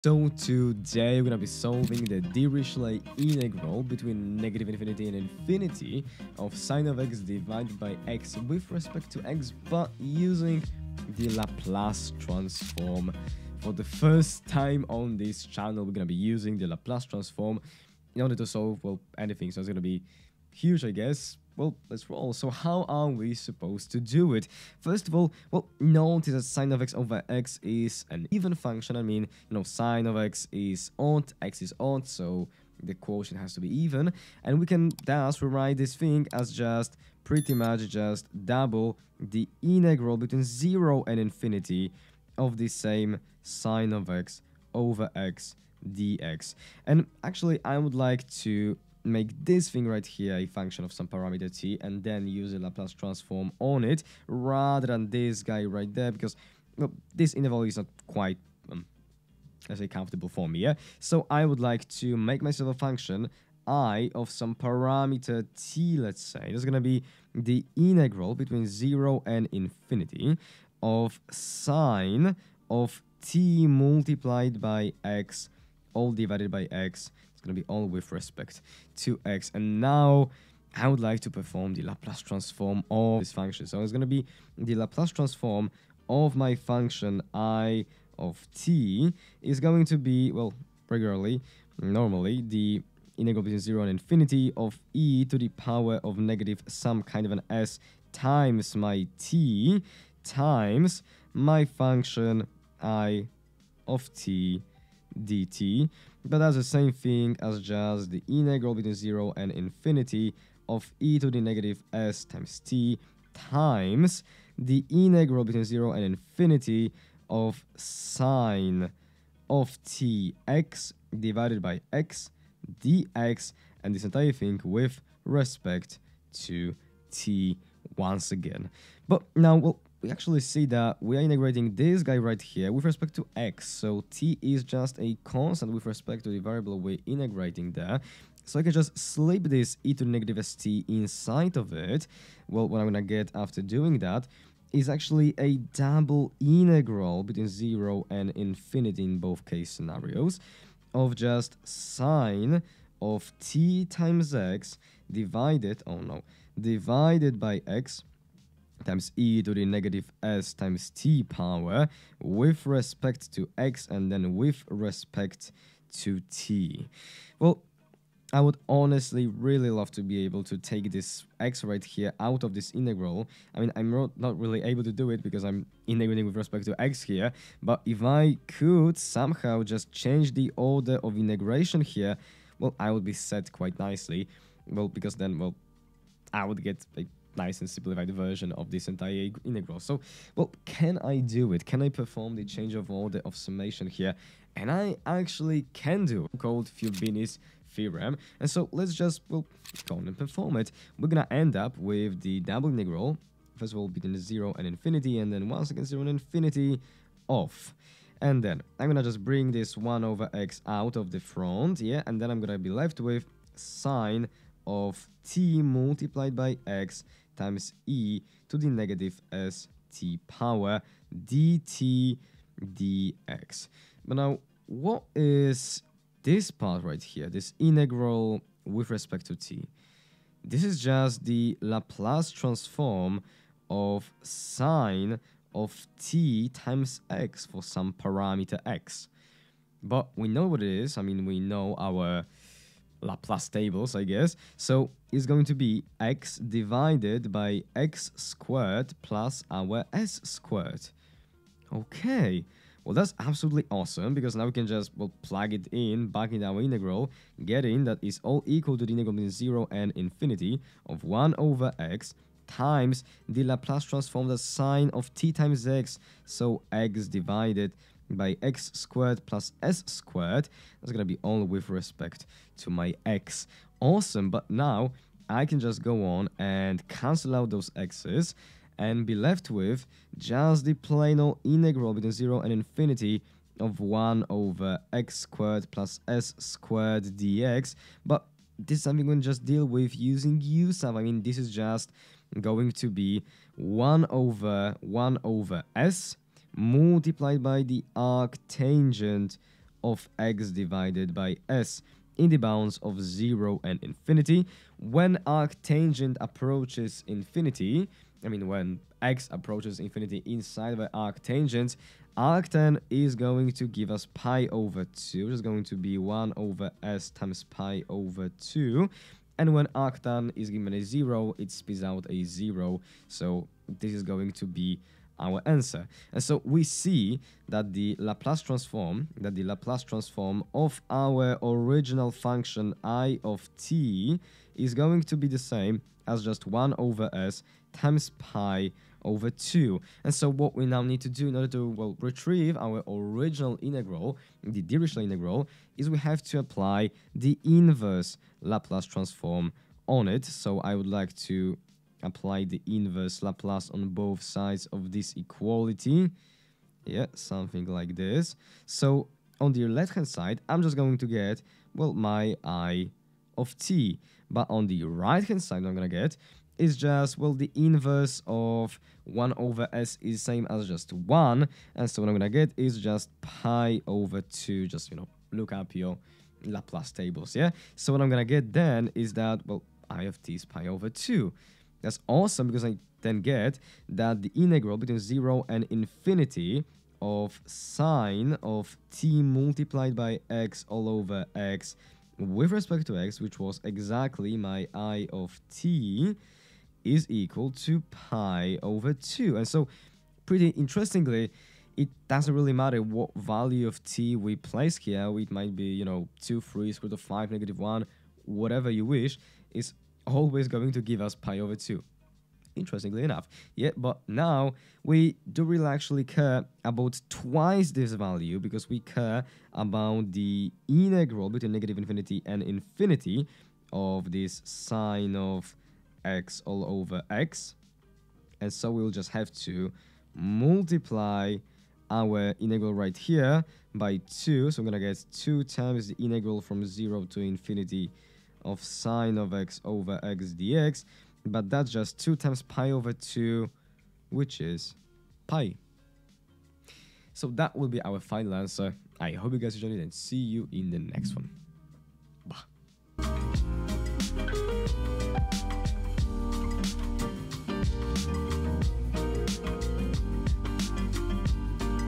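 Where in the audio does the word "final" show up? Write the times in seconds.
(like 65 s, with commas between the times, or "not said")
447 s.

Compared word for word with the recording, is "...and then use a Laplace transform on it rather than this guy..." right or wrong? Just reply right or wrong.
right.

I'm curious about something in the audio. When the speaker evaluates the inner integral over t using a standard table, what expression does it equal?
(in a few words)
x/(x^2+s^2).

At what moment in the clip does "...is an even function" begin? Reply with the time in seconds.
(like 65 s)
27 s.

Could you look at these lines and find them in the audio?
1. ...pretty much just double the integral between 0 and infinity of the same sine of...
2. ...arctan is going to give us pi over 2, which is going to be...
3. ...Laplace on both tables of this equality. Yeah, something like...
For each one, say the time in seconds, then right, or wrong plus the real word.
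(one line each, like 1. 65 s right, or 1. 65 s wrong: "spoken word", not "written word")
1. 37 s right
2. 312 s right
3. 353 s wrong: "sides", not "tables".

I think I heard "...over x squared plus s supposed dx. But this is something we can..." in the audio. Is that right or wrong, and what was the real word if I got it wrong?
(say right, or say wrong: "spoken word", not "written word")
wrong: "squared", not "supposed".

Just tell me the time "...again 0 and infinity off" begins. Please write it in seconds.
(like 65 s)
205 s.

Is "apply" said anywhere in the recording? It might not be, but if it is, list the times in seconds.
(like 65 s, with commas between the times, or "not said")
346 s, 352 s.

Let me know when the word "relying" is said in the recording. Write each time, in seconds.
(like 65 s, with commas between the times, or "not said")
not said.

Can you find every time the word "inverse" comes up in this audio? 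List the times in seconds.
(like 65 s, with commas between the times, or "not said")
347 s, 352 s, 367 s.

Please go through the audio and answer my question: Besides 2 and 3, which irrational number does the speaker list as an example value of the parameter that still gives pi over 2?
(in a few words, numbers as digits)
square root of 5.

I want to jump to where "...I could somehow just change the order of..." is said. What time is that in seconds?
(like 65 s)
178 s.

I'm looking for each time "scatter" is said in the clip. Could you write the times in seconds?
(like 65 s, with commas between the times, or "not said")
not said.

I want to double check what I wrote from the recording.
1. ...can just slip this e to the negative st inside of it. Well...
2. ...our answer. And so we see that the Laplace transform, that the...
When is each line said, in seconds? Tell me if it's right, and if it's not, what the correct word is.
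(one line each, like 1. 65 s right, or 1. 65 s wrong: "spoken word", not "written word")
1. 138 s right
2. 325 s right.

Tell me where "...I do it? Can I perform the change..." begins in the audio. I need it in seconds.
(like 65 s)
190 s.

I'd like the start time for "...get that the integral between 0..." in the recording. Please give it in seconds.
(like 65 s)
383 s.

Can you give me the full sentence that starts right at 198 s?
And so let's just, well, go on and perform it.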